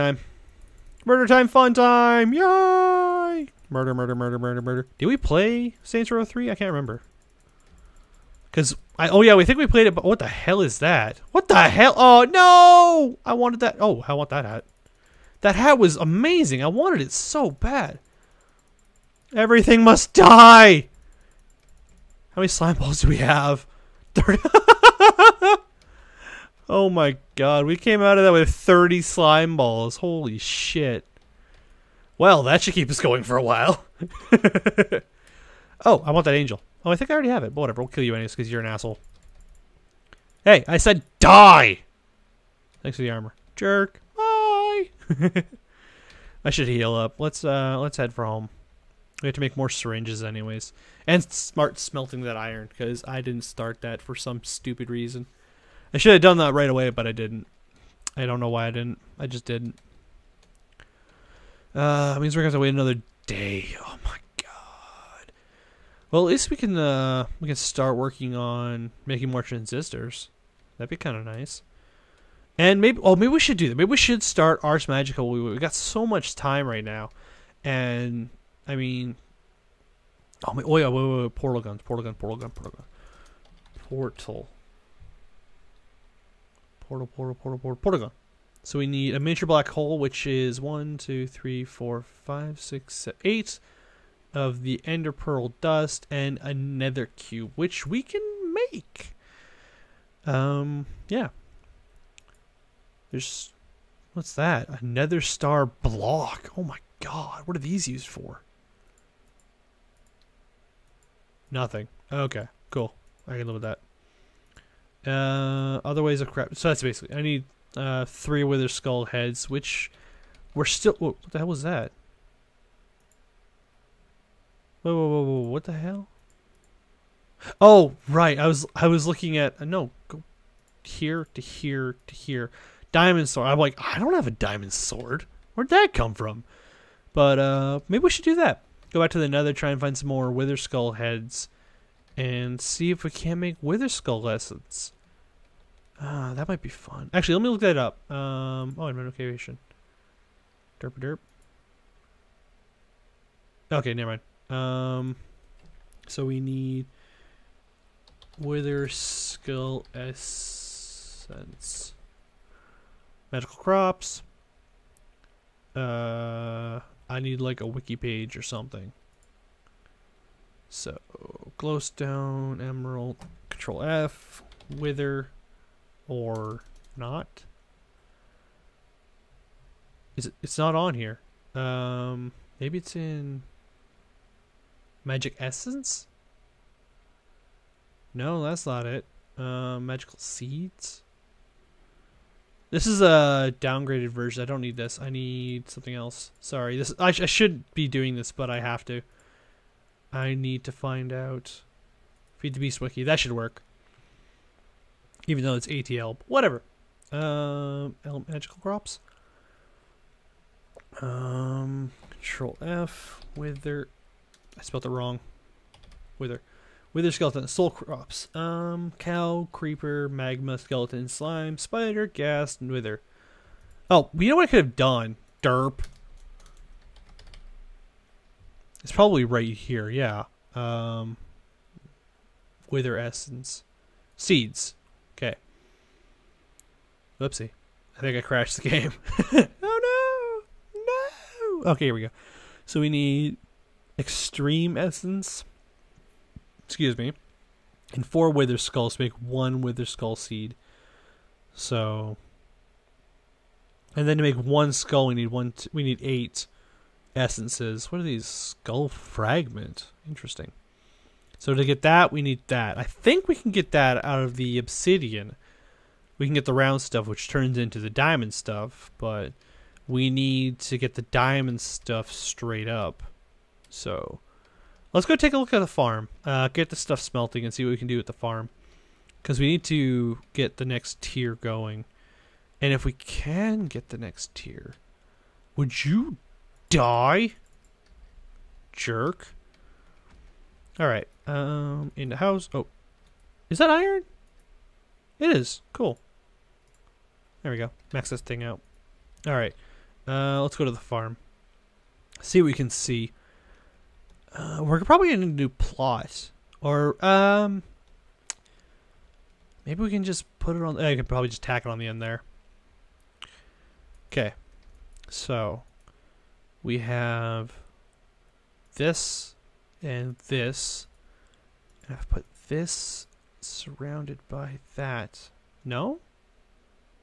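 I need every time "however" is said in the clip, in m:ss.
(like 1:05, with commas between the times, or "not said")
not said.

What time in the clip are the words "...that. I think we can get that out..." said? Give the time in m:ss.
4:22.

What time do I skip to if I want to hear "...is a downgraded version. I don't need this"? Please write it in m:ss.
3:12.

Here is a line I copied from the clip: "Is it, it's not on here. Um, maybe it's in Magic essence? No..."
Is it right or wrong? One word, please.
right.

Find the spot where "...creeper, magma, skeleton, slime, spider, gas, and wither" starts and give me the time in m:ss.
3:39.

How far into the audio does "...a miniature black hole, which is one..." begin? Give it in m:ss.
1:29.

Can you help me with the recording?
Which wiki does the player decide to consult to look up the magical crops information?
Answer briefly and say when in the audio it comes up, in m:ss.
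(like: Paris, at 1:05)
Feed the Beast Wiki, at 3:22.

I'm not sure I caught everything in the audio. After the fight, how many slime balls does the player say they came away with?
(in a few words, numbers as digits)
30.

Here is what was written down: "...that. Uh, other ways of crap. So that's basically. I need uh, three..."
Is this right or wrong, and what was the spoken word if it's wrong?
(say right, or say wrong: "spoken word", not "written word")
right.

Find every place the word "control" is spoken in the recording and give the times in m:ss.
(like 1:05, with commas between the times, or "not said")
2:53, 3:32.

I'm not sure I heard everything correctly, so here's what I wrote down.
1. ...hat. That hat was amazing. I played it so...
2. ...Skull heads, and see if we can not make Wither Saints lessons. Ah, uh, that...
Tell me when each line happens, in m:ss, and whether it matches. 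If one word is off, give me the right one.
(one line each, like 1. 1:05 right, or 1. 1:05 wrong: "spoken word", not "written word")
1. 0:14 wrong: "wanted", not "played"
2. 2:20 wrong: "Skull", not "Saints".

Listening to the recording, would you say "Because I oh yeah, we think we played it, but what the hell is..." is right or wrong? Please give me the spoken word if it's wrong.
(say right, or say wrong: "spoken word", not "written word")
right.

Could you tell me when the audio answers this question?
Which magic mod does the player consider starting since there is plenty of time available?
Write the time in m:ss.
1:14.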